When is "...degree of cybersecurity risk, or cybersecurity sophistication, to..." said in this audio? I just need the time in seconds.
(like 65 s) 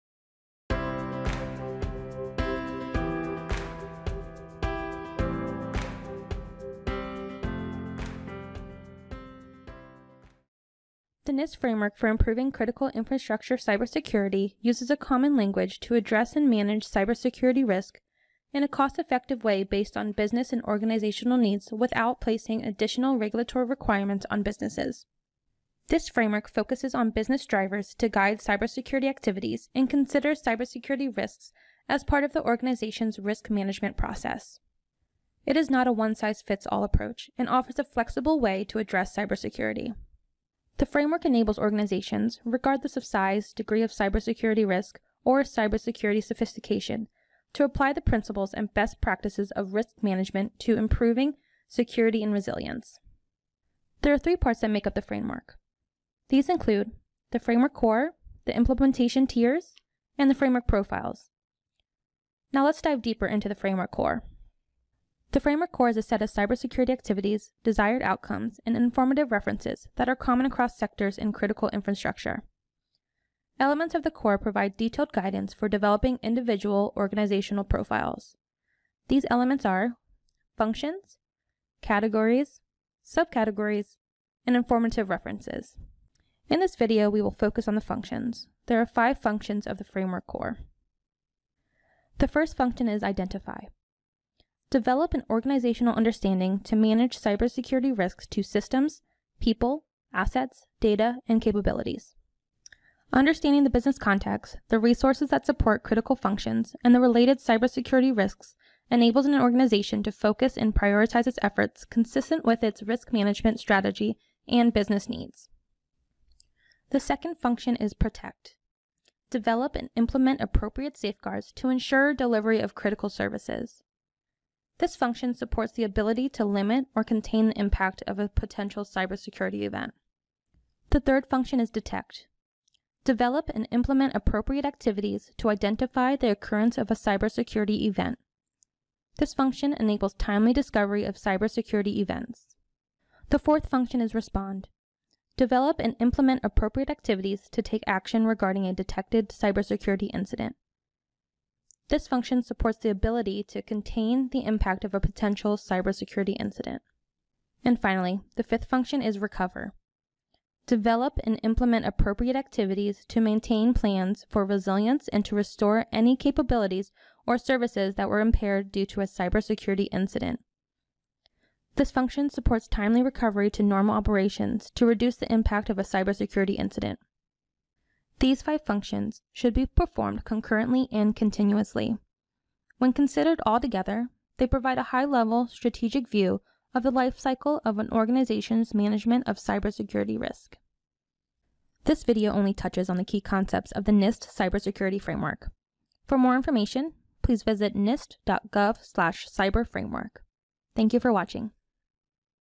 43 s.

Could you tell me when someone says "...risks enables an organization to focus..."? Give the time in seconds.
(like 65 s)
108 s.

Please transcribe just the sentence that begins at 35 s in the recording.
It is not a one-size-fits-all approach and offers a flexible way to address cybersecurity.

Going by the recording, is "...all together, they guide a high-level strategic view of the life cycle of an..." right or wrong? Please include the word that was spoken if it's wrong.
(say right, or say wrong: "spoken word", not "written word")
wrong: "provide", not "guide".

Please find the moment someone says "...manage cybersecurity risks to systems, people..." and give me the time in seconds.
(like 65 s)
96 s.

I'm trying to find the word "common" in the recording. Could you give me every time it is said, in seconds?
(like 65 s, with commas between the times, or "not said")
14 s, 70 s.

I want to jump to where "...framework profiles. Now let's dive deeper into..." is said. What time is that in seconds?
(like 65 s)
60 s.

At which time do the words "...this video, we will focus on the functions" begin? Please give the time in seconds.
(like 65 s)
86 s.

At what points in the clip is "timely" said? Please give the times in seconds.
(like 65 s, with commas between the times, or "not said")
140 s, 172 s.